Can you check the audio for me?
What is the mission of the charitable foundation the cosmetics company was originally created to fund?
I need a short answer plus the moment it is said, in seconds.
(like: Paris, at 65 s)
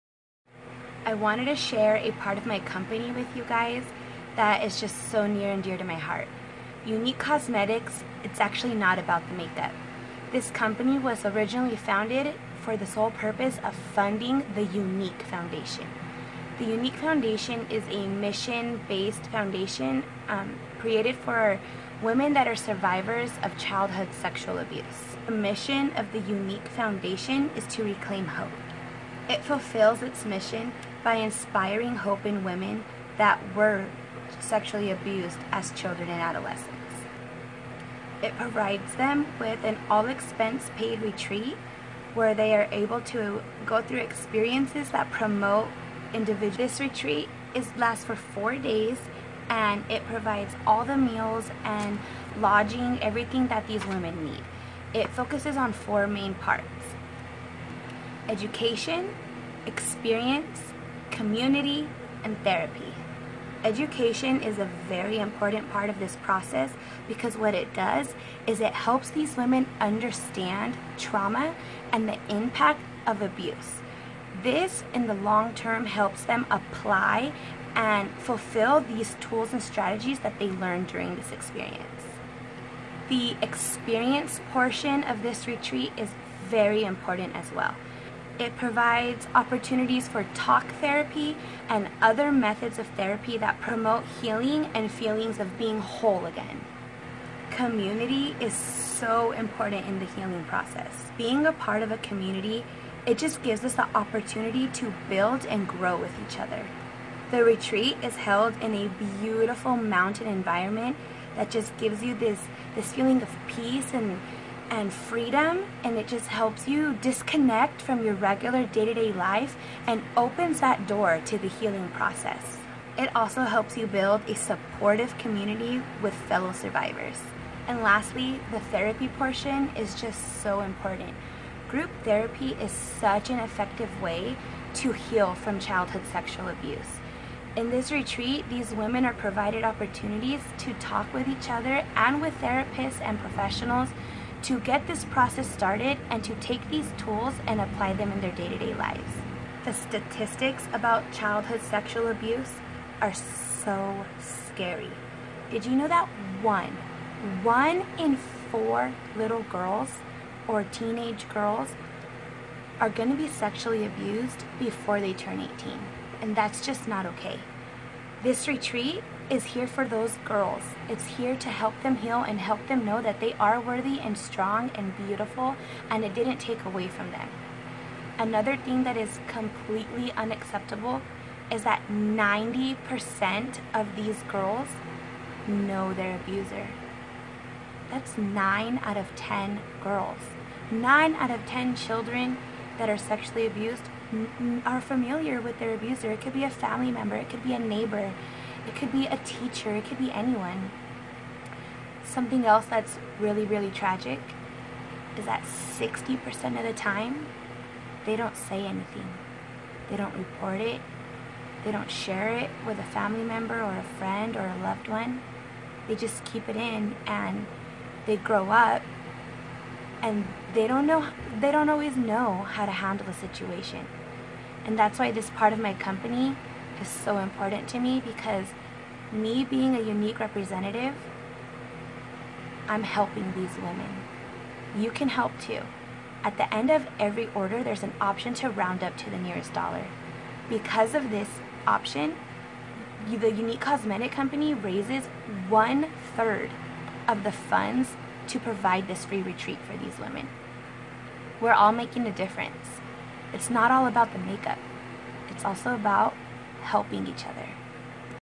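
Reclaim hope, at 27 s.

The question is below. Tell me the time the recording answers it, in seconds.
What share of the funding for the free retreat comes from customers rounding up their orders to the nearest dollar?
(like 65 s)
245 s.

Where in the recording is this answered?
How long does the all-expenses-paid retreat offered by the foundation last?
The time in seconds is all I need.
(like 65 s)
48 s.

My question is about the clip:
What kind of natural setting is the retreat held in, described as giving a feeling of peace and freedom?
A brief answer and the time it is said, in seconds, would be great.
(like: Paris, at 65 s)
Mountain environment, at 109 s.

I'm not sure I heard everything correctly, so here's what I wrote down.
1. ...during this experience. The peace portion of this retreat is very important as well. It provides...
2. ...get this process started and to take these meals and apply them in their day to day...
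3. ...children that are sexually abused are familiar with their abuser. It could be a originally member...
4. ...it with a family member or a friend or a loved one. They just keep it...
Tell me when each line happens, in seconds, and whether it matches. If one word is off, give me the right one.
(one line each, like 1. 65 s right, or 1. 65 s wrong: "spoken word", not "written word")
1. 80 s wrong: "experience", not "peace"
2. 144 s wrong: "tools", not "meals"
3. 191 s wrong: "family", not "originally"
4. 212 s right.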